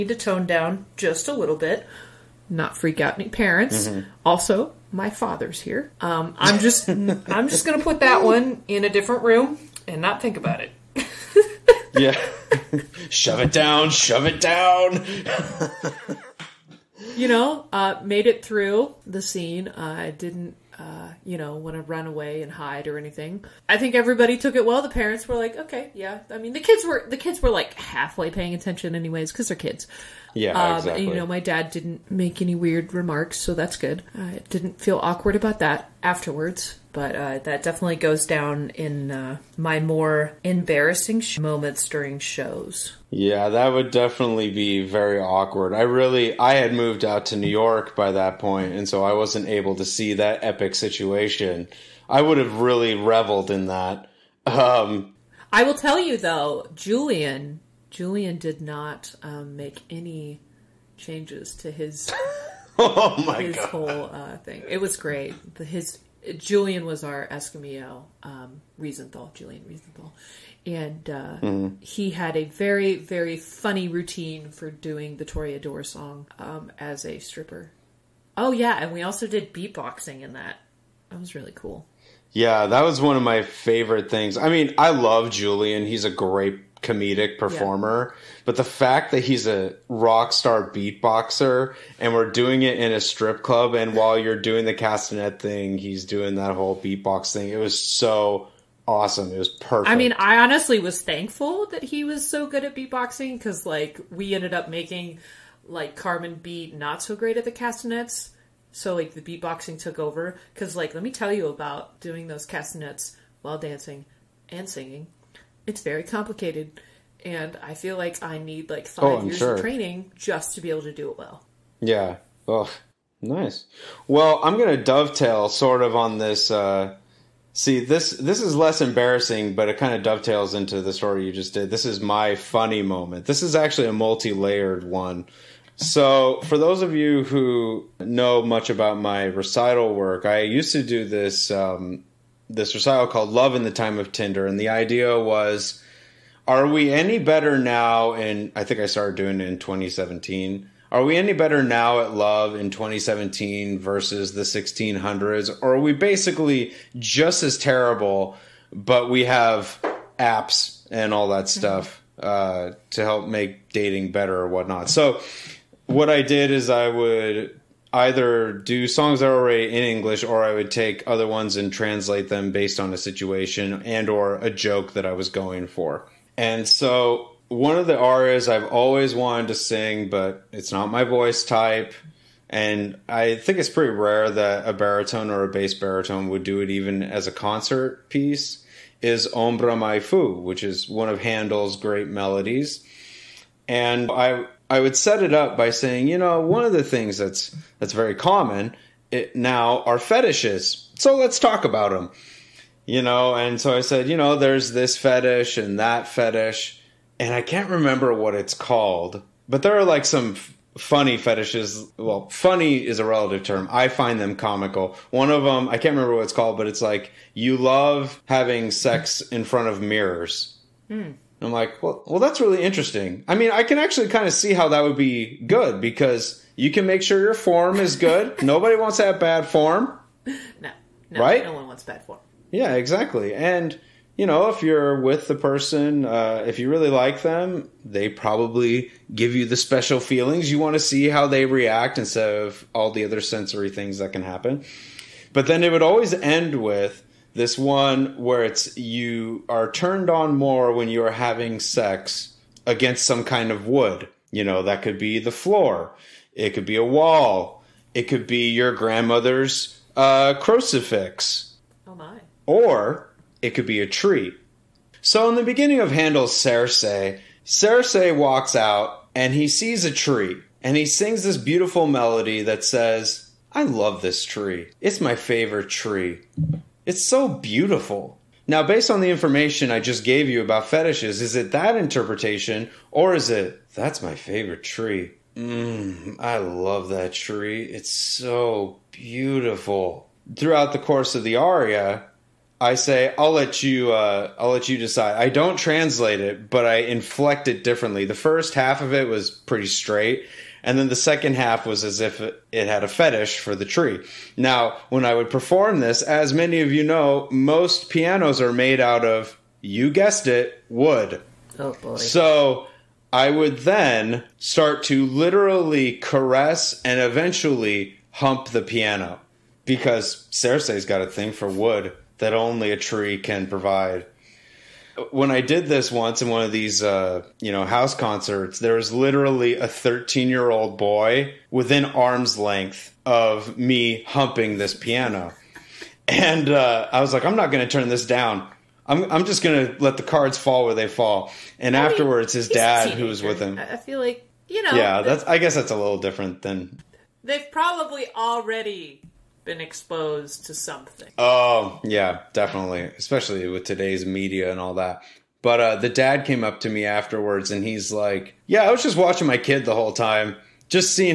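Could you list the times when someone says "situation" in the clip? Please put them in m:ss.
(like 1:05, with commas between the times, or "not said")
0:50, 2:52.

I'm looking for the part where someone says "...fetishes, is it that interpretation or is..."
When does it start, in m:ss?
4:40.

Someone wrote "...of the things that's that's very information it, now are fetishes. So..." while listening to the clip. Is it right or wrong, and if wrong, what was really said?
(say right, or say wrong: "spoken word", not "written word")
wrong: "common", not "information".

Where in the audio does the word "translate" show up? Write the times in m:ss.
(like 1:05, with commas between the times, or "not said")
2:51, 4:55.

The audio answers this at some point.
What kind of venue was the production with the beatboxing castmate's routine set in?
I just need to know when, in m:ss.
1:33.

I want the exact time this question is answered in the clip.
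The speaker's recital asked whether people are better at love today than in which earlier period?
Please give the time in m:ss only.
2:34.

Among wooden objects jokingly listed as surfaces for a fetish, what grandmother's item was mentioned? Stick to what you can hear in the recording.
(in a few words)
Crucifix.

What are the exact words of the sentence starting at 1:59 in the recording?
of training just to be able to do it well.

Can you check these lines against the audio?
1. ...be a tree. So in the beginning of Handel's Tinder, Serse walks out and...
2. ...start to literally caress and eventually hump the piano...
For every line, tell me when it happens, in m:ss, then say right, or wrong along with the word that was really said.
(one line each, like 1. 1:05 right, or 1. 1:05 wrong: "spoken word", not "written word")
1. 4:23 wrong: "Serse", not "Tinder"
2. 5:14 right.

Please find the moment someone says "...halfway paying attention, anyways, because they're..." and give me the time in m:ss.
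0:27.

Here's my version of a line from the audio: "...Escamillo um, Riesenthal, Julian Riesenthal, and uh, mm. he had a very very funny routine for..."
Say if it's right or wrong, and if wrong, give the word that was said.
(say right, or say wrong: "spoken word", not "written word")
right.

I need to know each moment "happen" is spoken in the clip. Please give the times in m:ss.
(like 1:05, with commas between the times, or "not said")
4:04.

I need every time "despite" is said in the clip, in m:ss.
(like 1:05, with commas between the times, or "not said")
not said.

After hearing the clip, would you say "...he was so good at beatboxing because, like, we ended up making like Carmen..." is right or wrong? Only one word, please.
right.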